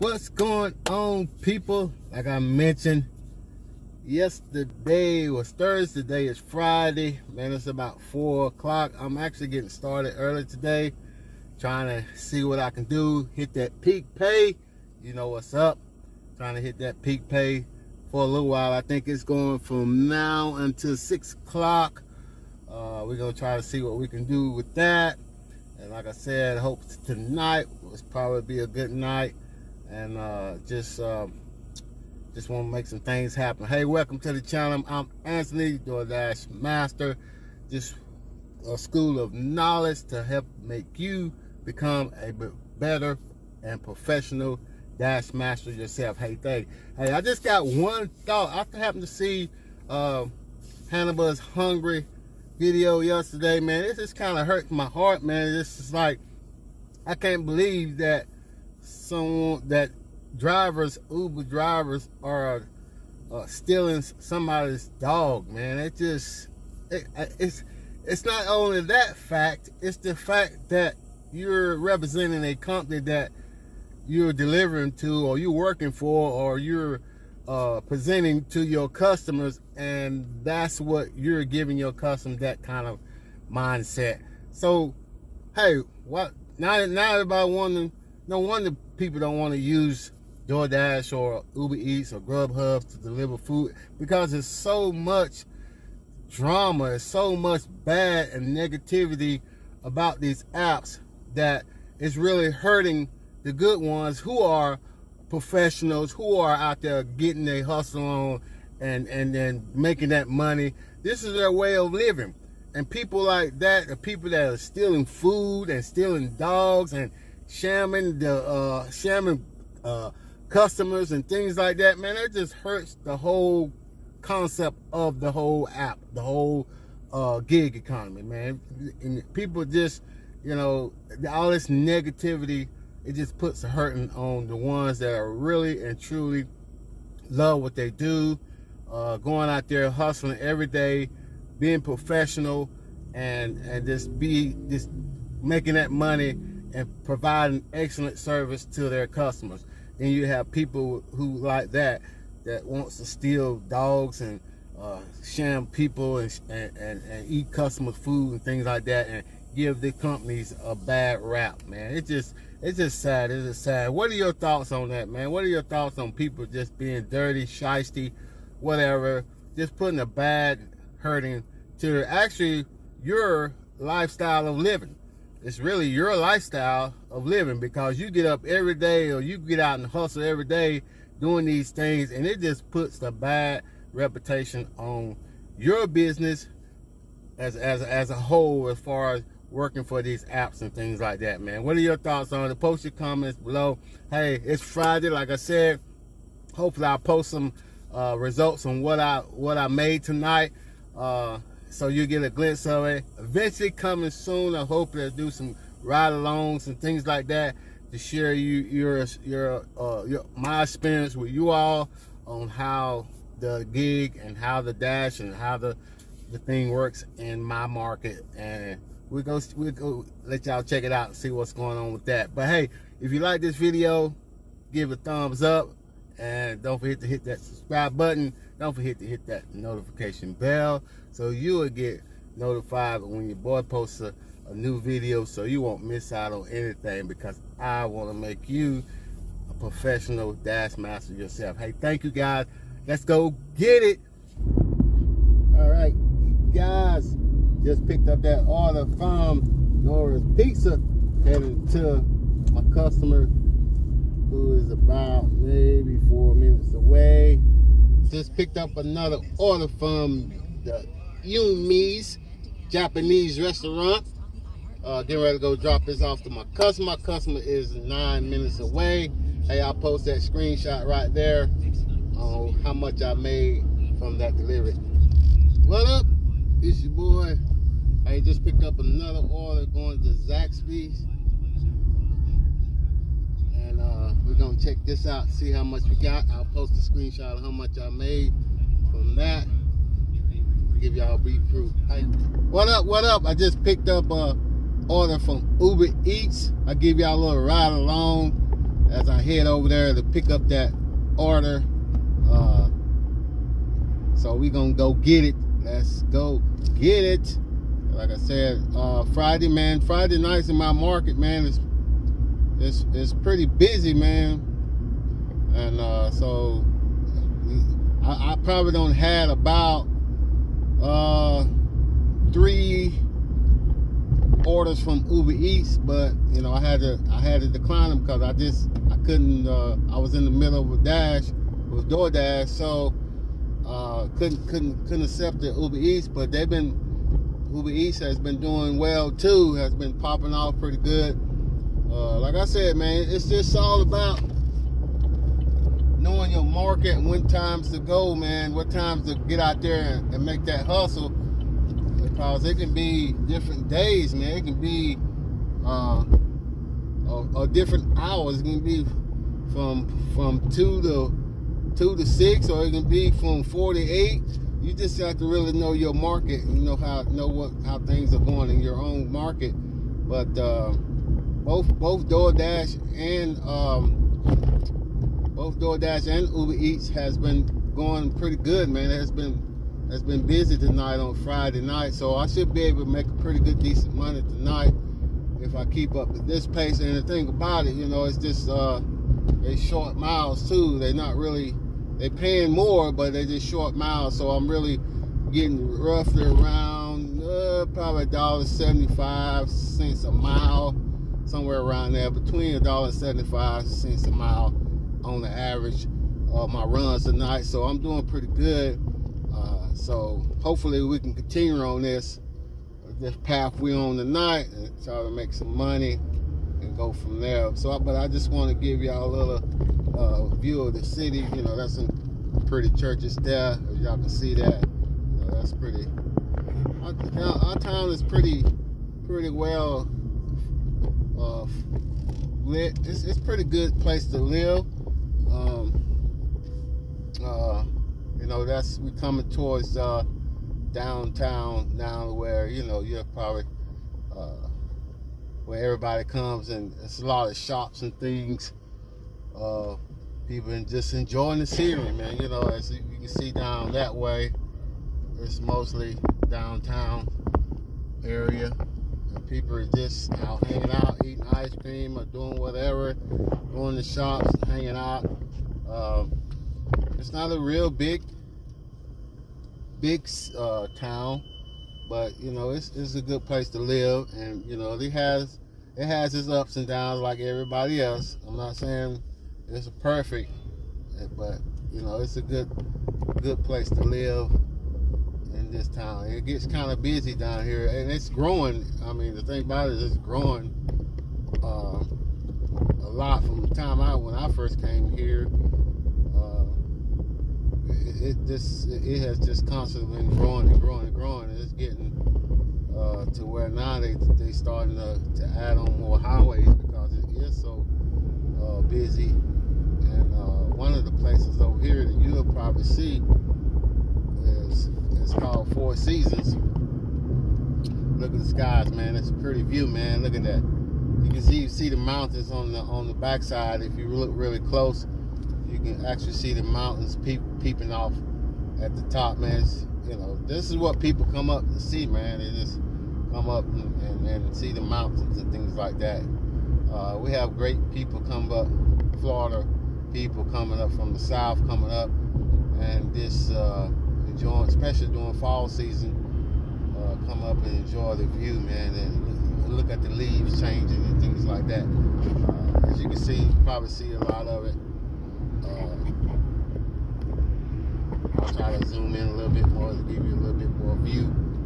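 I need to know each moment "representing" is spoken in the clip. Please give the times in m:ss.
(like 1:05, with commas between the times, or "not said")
1:11.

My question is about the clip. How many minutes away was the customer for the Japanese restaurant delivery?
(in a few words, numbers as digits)
9.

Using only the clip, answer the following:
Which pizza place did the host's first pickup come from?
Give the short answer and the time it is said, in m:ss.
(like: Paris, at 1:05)
Nora's Pizza, at 4:09.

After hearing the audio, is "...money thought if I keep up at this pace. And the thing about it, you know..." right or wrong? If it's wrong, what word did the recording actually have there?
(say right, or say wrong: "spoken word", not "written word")
wrong: "tonight", not "thought".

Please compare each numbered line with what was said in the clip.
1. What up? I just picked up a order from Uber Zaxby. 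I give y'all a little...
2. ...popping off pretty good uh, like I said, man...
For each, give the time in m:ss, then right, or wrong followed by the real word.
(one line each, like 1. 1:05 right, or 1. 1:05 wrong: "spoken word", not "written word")
1. 4:52 wrong: "Eats", not "Zaxby"
2. 5:39 right.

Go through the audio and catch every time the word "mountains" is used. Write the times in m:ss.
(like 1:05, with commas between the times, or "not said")
8:41, 8:46, 8:54.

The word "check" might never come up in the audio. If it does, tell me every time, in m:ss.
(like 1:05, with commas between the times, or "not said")
3:40, 4:44.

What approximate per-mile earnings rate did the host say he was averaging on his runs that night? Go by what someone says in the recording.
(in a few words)
$1.75.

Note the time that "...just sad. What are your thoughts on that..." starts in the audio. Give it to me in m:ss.
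2:43.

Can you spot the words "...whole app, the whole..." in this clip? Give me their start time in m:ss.
2:05.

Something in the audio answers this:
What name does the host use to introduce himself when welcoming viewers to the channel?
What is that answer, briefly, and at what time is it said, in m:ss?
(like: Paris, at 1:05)
Anthony DoorDash Master, at 0:35.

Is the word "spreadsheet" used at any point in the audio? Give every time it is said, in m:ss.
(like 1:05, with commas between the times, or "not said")
not said.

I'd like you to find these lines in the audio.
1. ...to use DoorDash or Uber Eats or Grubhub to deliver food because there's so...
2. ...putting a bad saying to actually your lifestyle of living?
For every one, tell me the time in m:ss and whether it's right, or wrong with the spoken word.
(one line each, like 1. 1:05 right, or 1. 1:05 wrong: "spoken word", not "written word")
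1. 1:29 right
2. 2:49 wrong: "hurting", not "saying".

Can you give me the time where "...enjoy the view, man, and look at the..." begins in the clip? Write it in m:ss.
9:07.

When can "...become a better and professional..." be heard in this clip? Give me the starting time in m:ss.
0:41.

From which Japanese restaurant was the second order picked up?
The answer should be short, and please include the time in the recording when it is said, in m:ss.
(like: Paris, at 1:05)
Yumi's, at 4:21.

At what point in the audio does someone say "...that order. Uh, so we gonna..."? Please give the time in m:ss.
5:00.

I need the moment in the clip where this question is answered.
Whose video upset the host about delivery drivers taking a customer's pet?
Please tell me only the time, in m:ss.
0:50.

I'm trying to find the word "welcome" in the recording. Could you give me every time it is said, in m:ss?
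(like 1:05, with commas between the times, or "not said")
0:33.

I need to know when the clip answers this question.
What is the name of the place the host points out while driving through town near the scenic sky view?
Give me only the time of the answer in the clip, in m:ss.
8:35.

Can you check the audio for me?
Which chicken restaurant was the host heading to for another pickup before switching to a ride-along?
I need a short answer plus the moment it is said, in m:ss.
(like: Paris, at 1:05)
Zaxby's, at 4:40.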